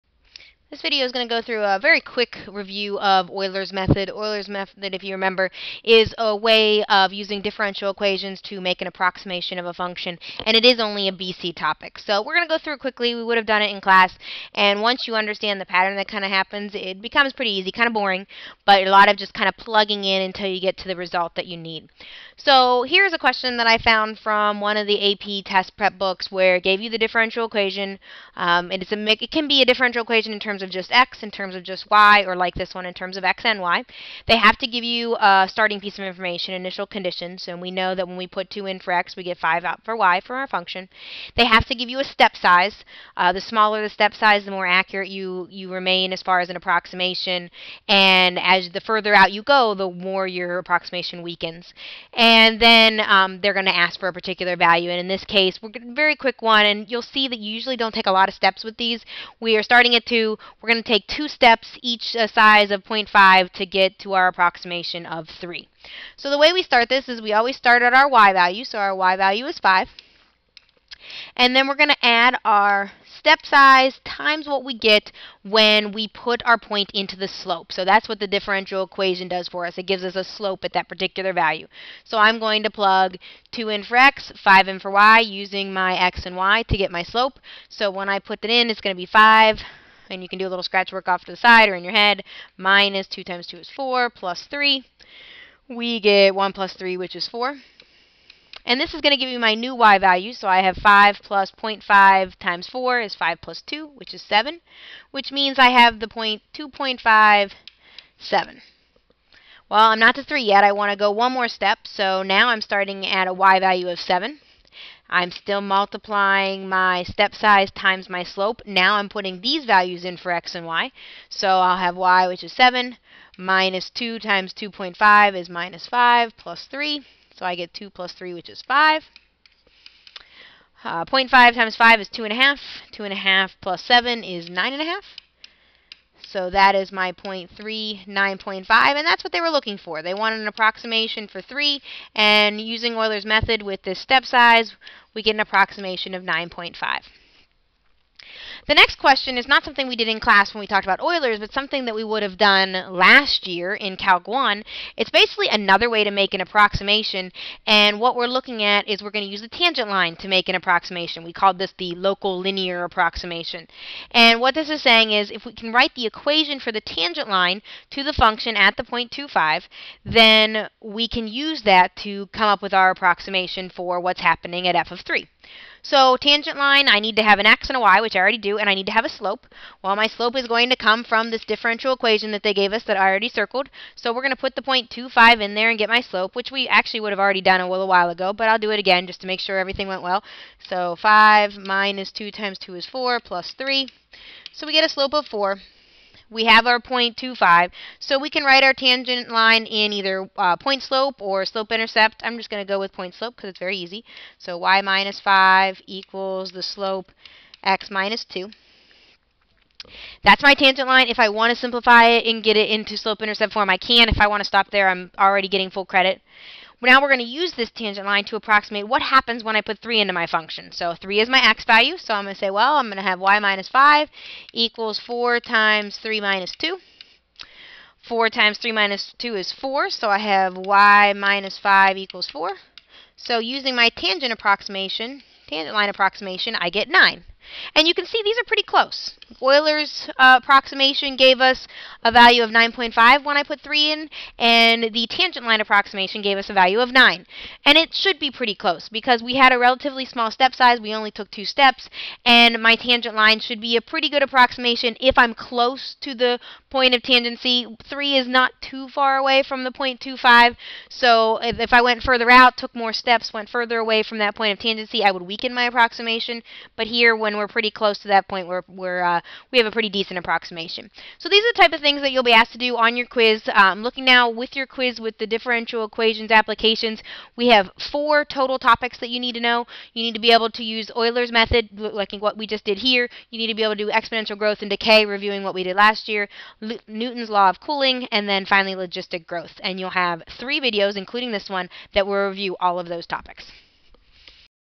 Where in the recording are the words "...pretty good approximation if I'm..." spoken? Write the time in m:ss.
4:13.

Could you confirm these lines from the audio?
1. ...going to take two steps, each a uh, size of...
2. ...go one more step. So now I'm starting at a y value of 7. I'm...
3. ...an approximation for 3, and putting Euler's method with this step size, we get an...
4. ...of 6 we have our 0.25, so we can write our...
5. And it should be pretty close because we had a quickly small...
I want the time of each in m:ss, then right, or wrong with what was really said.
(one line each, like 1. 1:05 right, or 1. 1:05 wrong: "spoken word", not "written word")
1. 1:00 right
2. 1:50 right
3. 2:20 wrong: "using", not "putting"
4. 3:15 wrong: "4", not "6"
5. 4:07 wrong: "relatively", not "quickly".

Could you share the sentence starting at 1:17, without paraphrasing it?
So that's what the differential equation does for us.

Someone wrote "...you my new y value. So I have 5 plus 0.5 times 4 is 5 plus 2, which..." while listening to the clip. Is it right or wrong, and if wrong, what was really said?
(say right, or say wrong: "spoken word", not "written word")
right.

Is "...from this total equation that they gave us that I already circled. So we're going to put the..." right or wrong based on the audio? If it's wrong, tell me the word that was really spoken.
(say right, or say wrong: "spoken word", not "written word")
wrong: "differential", not "total".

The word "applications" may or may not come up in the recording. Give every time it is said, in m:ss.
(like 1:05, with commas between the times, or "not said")
4:36.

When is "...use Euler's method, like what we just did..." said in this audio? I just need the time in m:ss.
4:40.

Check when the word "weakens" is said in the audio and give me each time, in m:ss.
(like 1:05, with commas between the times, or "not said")
0:51, 4:25.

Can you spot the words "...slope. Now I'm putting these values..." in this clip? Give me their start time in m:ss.
1:58.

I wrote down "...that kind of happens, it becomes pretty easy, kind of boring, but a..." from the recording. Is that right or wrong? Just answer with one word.
right.